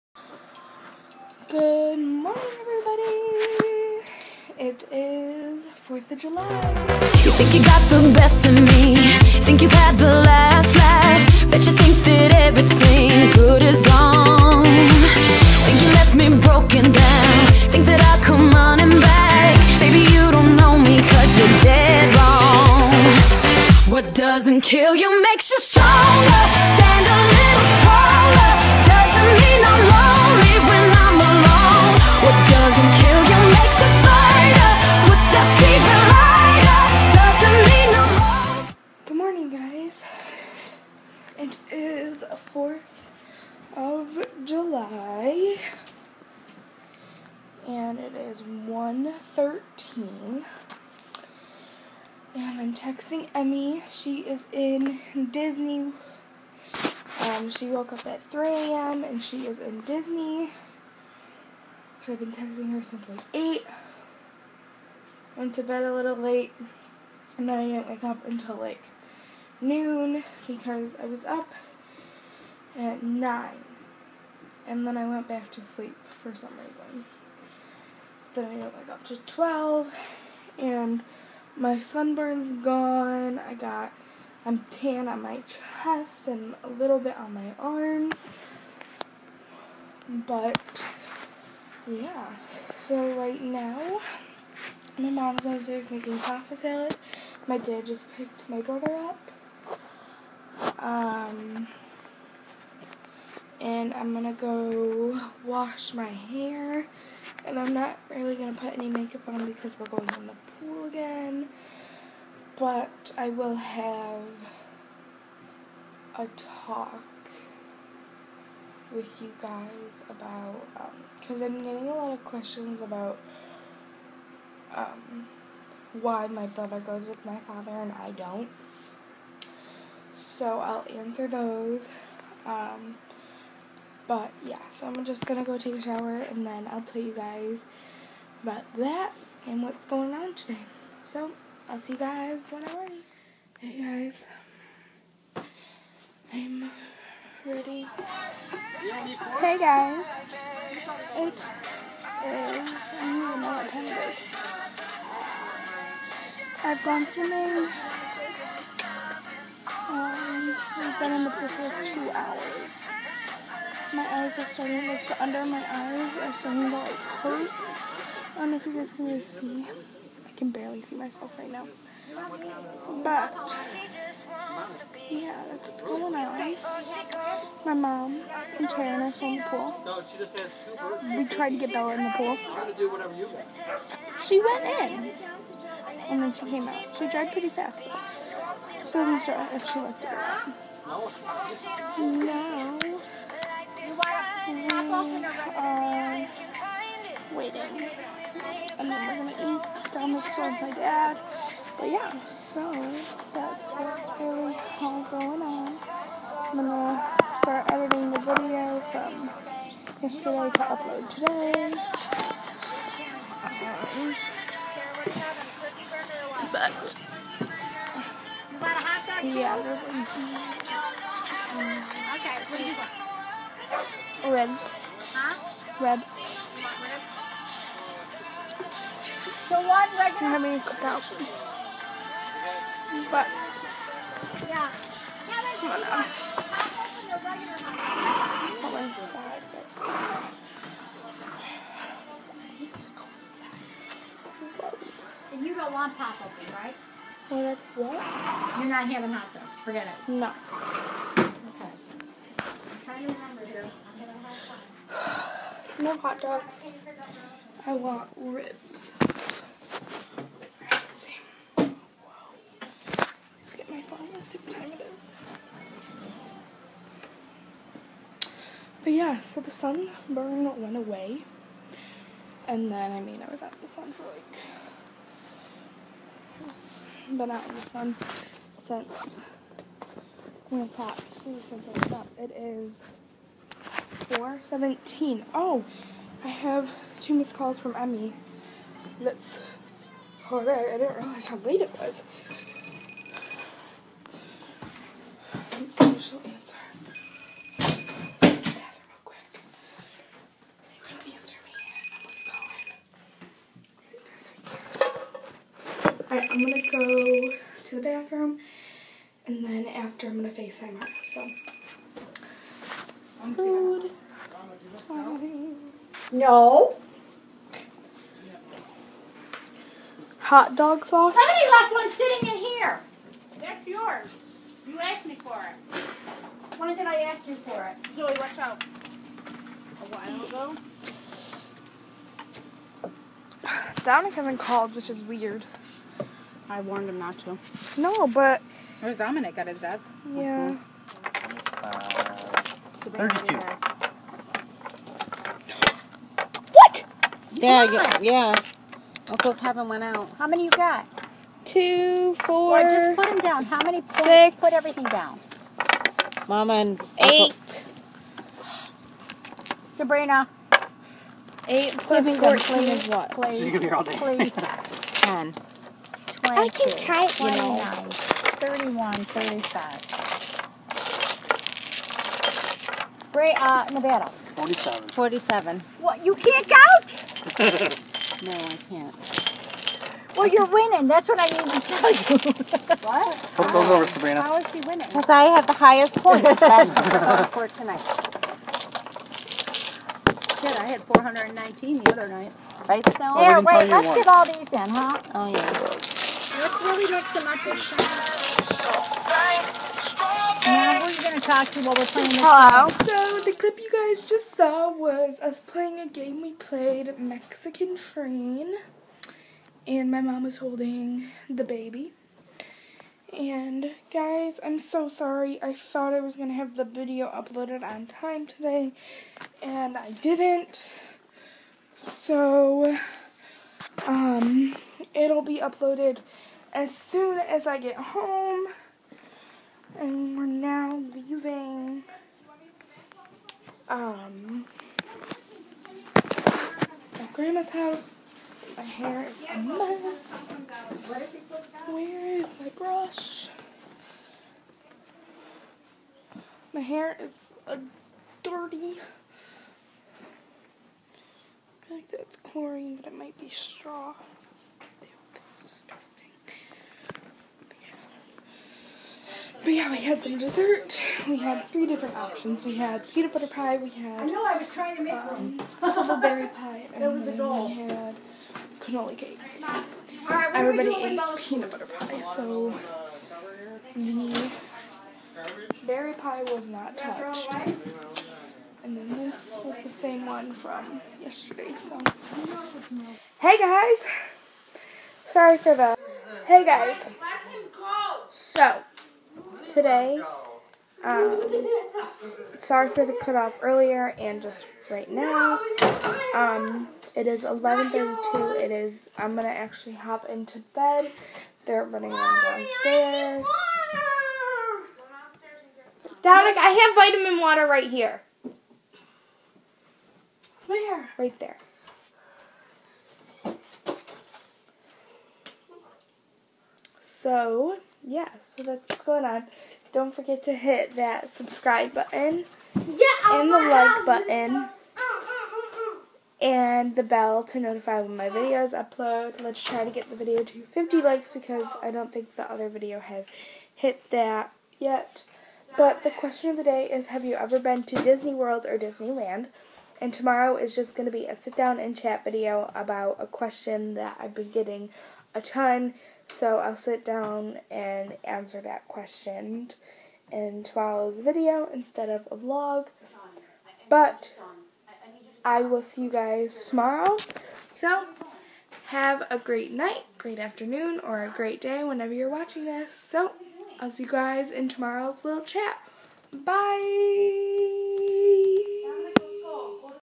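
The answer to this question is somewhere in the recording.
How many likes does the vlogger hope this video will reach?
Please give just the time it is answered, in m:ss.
8:50.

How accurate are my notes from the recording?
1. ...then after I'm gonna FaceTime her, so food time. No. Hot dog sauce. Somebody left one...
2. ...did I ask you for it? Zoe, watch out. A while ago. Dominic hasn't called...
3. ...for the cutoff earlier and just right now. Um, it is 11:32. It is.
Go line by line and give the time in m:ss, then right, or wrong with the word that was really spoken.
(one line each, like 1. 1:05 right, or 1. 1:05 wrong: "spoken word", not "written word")
1. 5:09 right
2. 5:26 right
3. 8:12 right.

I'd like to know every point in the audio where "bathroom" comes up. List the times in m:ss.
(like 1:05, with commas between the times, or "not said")
5:07.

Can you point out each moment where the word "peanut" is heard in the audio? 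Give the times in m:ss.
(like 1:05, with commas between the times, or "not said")
7:42, 7:51.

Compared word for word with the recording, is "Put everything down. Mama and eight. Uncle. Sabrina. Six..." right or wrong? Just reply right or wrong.
wrong.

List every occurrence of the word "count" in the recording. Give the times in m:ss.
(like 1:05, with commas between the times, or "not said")
6:06, 6:16.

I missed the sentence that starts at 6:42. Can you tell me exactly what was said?
So the clip you guys just saw was us playing a game we played, Mexican Train.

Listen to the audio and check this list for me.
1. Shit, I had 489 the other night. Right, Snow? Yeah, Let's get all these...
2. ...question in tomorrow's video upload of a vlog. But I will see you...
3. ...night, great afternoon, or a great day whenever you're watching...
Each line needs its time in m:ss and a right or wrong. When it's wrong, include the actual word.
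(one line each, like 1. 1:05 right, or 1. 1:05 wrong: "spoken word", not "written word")
1. 6:30 wrong: "419", not "489"
2. 9:08 wrong: "instead", not "upload"
3. 9:19 right.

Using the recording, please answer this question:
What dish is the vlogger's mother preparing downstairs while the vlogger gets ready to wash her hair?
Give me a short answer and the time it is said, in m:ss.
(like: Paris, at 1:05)
Pasta salad, at 1:36.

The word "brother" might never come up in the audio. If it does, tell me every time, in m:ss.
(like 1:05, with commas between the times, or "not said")
1:38, 2:06.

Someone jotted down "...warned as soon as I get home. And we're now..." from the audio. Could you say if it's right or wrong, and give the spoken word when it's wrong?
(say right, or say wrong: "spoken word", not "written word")
wrong: "uploaded", not "warned".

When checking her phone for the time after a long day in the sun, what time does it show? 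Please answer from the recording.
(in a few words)
4:17.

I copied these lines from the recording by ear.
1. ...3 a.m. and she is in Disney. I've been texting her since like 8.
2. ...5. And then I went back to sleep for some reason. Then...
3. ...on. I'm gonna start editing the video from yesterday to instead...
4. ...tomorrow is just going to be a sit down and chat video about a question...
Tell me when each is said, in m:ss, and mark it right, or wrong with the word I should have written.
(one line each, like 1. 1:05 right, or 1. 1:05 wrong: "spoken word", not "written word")
1. 0:58 right
2. 1:13 wrong: "9", not "5"
3. 3:25 wrong: "upload", not "instead"
4. 8:59 right.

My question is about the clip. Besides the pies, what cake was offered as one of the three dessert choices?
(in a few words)
Cannoli cake.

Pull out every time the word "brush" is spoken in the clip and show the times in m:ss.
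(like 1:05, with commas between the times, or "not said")
7:22.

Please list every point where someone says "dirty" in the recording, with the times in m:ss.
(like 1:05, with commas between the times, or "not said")
7:28.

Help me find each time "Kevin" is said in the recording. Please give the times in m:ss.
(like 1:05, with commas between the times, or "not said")
5:49.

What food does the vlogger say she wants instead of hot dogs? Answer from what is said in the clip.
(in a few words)
Ribs.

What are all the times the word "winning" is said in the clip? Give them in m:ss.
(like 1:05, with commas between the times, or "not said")
6:20, 6:24.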